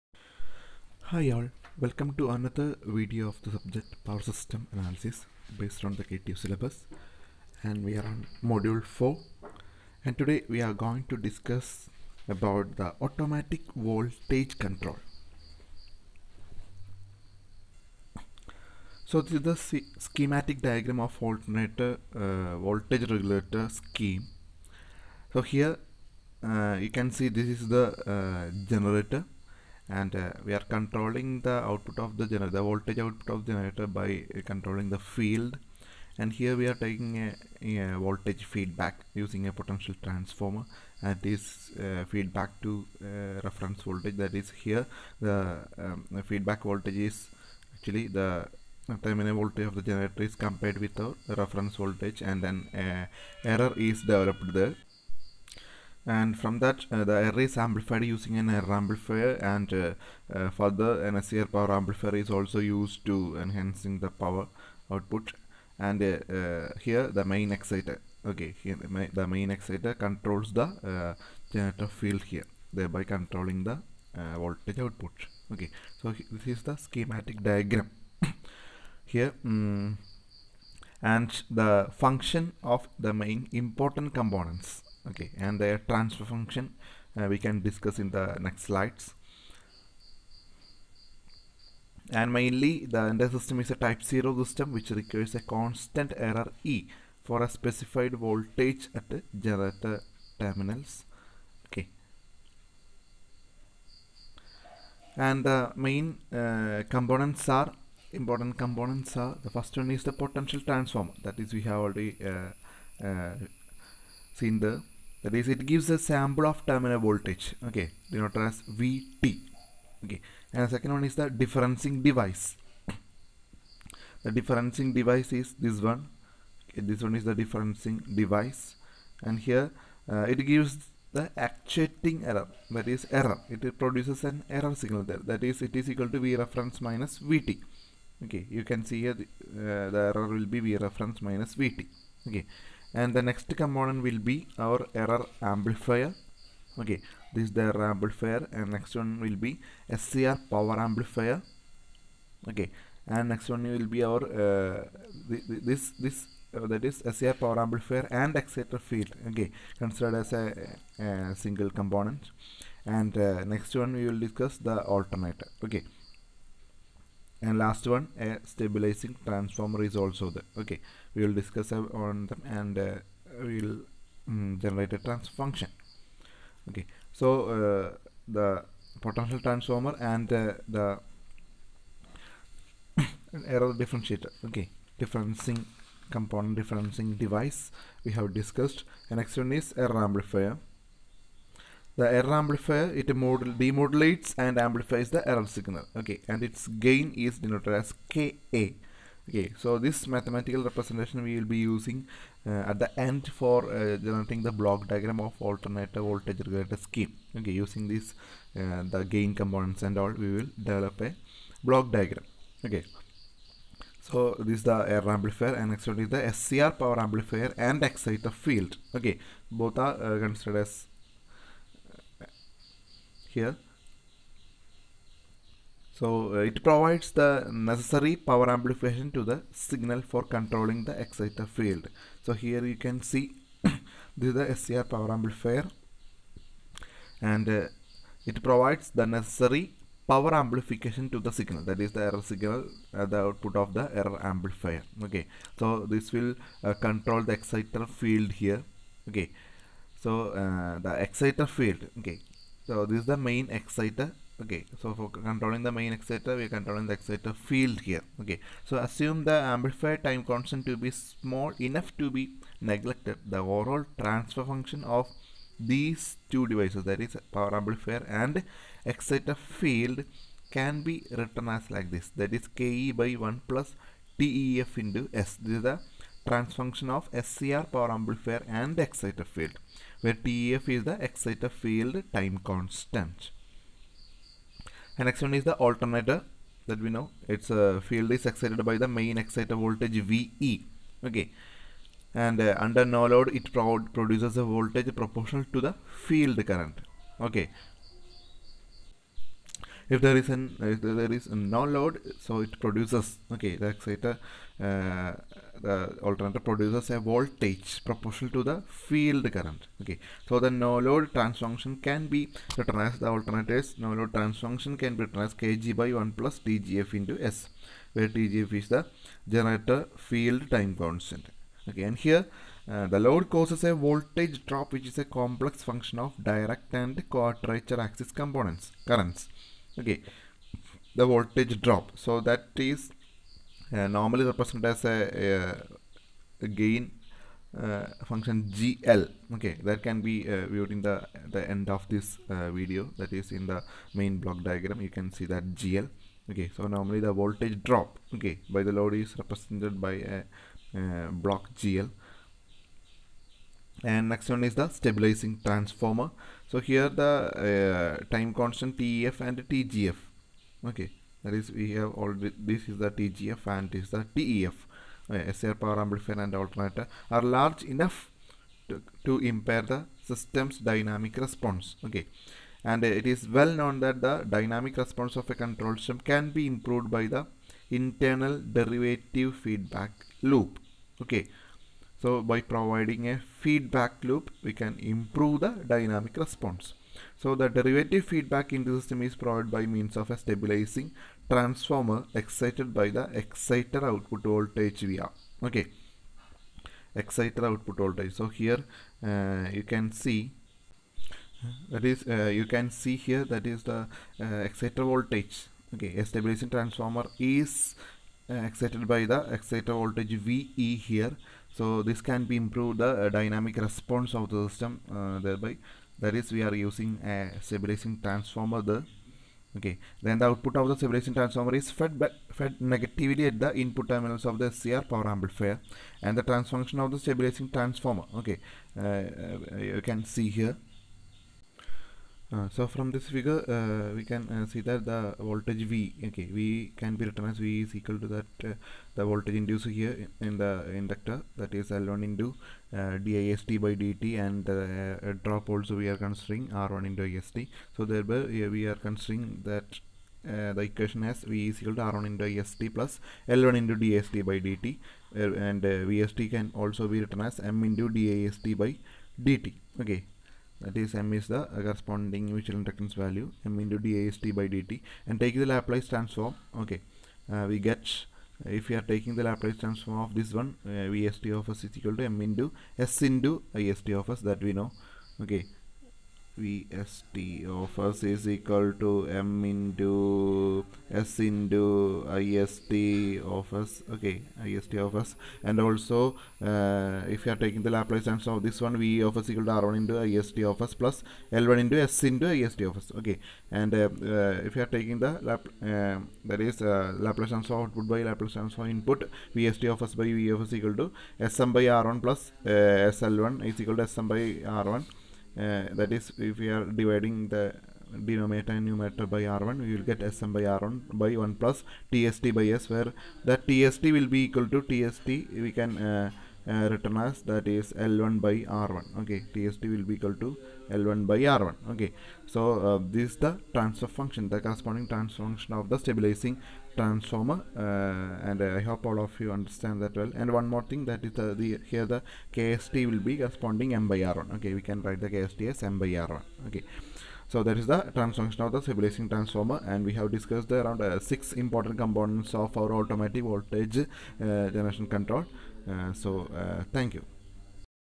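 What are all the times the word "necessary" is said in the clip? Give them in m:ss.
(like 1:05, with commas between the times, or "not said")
3:47, 3:59.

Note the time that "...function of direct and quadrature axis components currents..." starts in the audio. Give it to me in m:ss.
5:25.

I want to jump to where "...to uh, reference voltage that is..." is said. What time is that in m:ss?
0:42.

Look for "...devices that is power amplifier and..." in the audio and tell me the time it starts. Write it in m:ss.
4:26.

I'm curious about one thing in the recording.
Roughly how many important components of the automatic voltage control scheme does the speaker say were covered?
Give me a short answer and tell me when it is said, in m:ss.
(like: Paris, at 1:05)
6, at 9:00.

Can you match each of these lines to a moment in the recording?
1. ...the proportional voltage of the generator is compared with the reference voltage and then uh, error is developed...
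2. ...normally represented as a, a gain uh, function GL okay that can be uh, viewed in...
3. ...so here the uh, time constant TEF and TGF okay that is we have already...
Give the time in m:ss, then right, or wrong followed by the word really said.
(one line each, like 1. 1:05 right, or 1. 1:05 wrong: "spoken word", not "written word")
1. 0:48 wrong: "terminal", not "proportional"
2. 5:33 right
3. 5:56 right.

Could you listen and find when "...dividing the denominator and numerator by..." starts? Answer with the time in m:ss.
8:26.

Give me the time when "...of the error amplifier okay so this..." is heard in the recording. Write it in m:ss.
4:03.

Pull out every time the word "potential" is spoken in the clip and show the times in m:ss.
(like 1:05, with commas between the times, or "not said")
0:39, 1:50, 2:59.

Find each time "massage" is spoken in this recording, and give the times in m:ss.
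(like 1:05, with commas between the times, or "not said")
not said.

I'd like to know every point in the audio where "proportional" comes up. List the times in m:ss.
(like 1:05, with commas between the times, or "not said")
4:54, 5:07.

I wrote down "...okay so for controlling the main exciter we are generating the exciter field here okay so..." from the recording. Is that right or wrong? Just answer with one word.
wrong.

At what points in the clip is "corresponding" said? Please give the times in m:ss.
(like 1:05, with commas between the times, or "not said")
7:41, 8:44, 8:53.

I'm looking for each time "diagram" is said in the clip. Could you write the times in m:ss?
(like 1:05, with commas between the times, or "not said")
0:20, 1:17, 3:24, 3:31, 5:44.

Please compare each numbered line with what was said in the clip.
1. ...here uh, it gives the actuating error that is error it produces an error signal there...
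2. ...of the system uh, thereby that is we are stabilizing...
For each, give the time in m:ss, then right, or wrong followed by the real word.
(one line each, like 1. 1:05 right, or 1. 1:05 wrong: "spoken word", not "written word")
1. 2:09 right
2. 6:54 wrong: "using", not "stabilizing".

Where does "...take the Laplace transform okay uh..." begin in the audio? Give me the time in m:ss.
7:45.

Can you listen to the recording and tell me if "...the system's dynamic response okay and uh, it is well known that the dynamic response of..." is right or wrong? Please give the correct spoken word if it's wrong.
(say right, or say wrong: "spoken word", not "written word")
right.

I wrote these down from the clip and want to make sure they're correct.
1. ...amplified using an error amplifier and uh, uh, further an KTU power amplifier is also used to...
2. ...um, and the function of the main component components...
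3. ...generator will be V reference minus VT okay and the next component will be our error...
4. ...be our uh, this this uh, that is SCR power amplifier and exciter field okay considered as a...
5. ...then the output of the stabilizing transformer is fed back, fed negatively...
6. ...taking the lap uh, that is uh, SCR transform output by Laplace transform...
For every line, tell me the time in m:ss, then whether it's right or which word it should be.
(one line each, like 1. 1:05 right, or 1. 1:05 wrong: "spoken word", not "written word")
1. 0:57 wrong: "SCR", not "KTU"
2. 1:19 wrong: "important", not "component"
3. 2:20 wrong: "error", not "generator"
4. 2:33 right
5. 7:00 right
6. 8:14 wrong: "Laplace", not "SCR".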